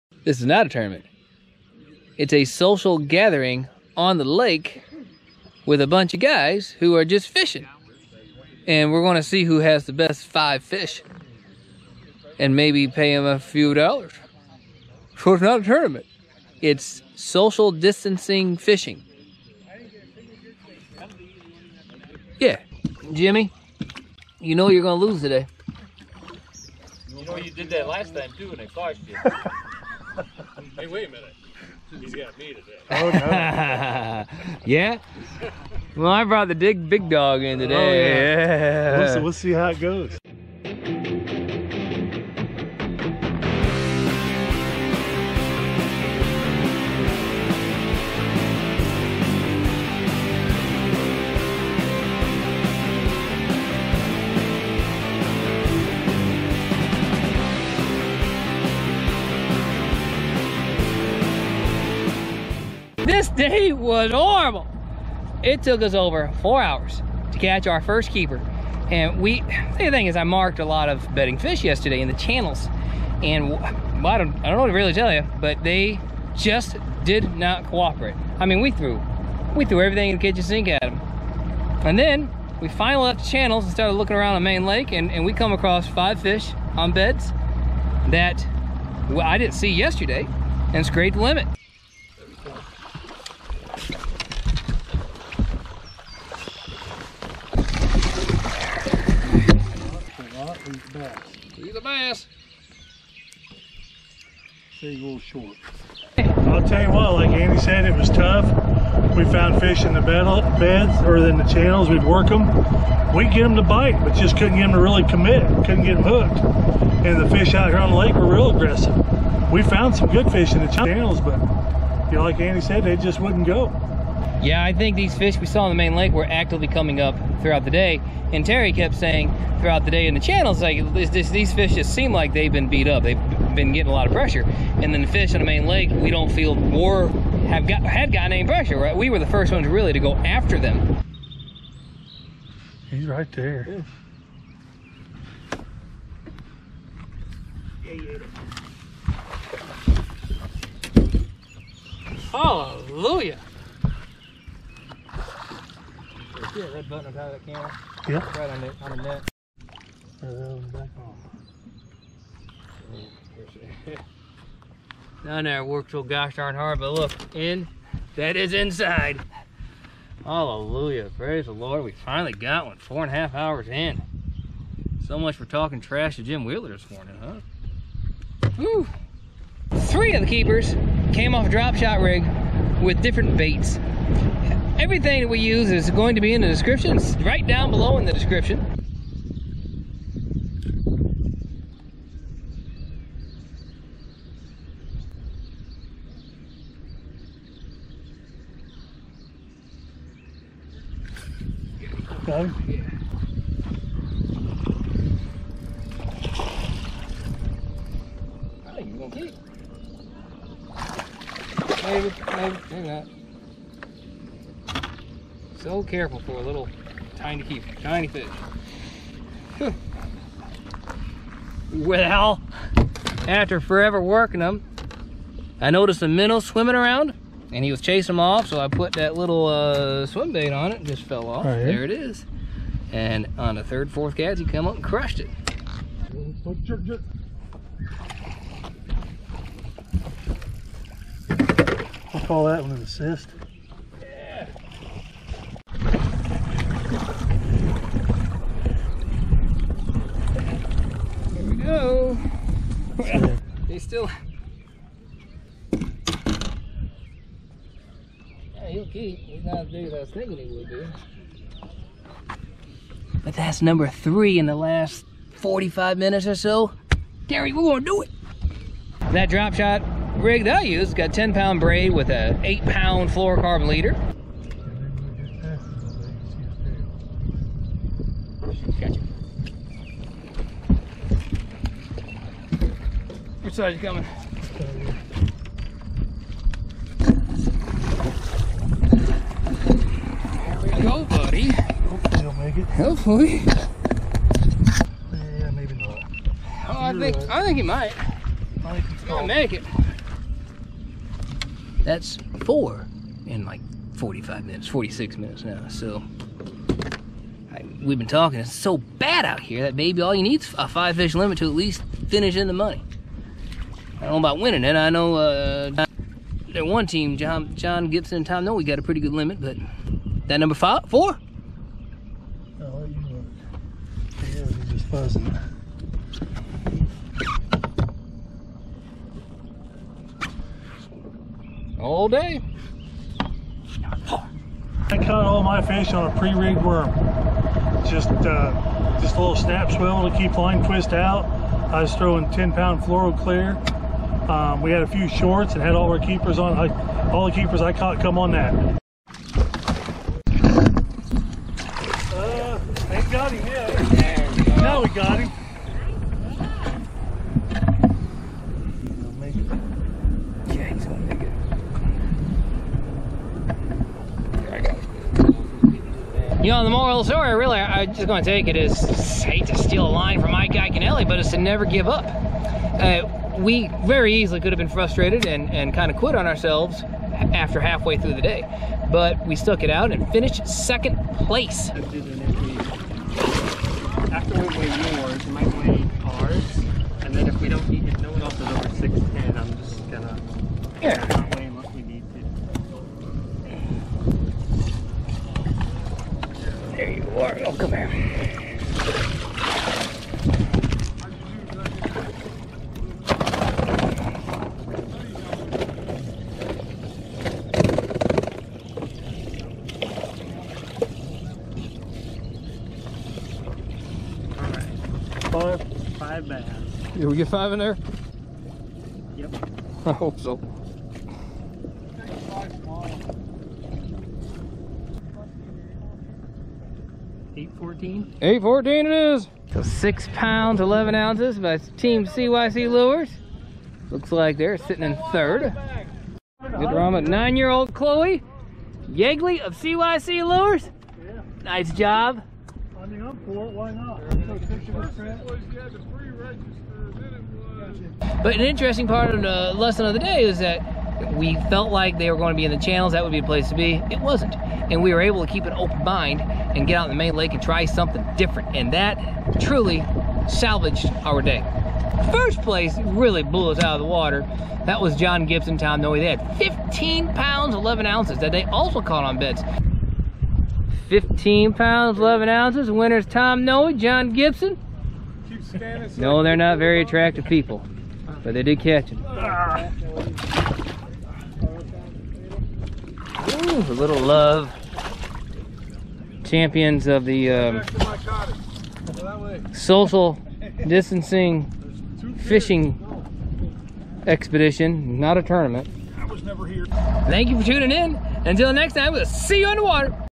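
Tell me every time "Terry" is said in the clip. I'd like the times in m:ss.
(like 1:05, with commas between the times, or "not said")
2:08, 4:27.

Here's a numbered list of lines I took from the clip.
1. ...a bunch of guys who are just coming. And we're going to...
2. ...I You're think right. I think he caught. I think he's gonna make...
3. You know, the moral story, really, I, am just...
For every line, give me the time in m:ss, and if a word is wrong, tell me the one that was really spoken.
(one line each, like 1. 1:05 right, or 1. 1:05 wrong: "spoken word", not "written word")
1. 0:05 wrong: "fishing", not "coming"
2. 4:56 wrong: "might", not "caught"
3. 6:06 right.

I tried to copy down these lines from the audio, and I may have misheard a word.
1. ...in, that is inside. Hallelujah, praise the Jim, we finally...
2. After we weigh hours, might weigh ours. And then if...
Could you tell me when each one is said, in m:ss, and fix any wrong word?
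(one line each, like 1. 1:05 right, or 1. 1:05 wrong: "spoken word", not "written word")
1. 2:47 wrong: "Lord", not "Jim"
2. 6:21 wrong: "yours", not "hours".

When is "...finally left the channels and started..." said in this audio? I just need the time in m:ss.
1:22.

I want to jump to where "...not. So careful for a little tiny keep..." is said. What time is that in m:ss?
3:32.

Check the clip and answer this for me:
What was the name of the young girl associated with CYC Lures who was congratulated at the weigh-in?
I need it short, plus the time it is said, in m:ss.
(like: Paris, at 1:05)
Chloe Yegley, at 7:17.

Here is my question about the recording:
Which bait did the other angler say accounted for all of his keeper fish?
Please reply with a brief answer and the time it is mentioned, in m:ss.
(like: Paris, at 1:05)
Pre-rigged worm, at 5:36.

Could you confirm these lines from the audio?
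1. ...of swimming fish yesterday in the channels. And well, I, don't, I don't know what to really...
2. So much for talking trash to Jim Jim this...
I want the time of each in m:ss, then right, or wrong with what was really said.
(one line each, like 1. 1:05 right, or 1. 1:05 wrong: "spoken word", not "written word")
1. 1:10 wrong: "bedding", not "swimming"
2. 2:55 wrong: "Wheeler", not "Jim".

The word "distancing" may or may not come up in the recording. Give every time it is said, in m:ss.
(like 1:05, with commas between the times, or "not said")
0:17, 8:10.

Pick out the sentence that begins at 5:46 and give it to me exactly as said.
I, all the keepers I caught come on that.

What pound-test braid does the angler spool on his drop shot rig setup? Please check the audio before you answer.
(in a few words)
10 pound.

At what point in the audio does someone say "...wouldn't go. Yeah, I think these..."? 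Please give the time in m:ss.
2:03.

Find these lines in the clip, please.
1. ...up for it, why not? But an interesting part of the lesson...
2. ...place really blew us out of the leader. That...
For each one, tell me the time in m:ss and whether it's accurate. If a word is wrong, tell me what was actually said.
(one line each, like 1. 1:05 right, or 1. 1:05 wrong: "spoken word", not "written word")
1. 7:22 right
2. 7:42 wrong: "water", not "leader".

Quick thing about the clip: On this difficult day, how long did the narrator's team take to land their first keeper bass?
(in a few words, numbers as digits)
Over 4 hours.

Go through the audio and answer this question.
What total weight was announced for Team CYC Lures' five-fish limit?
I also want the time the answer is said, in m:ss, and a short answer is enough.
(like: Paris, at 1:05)
6 pounds 11 ounces, at 7:09.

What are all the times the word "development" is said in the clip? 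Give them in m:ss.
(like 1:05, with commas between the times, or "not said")
not said.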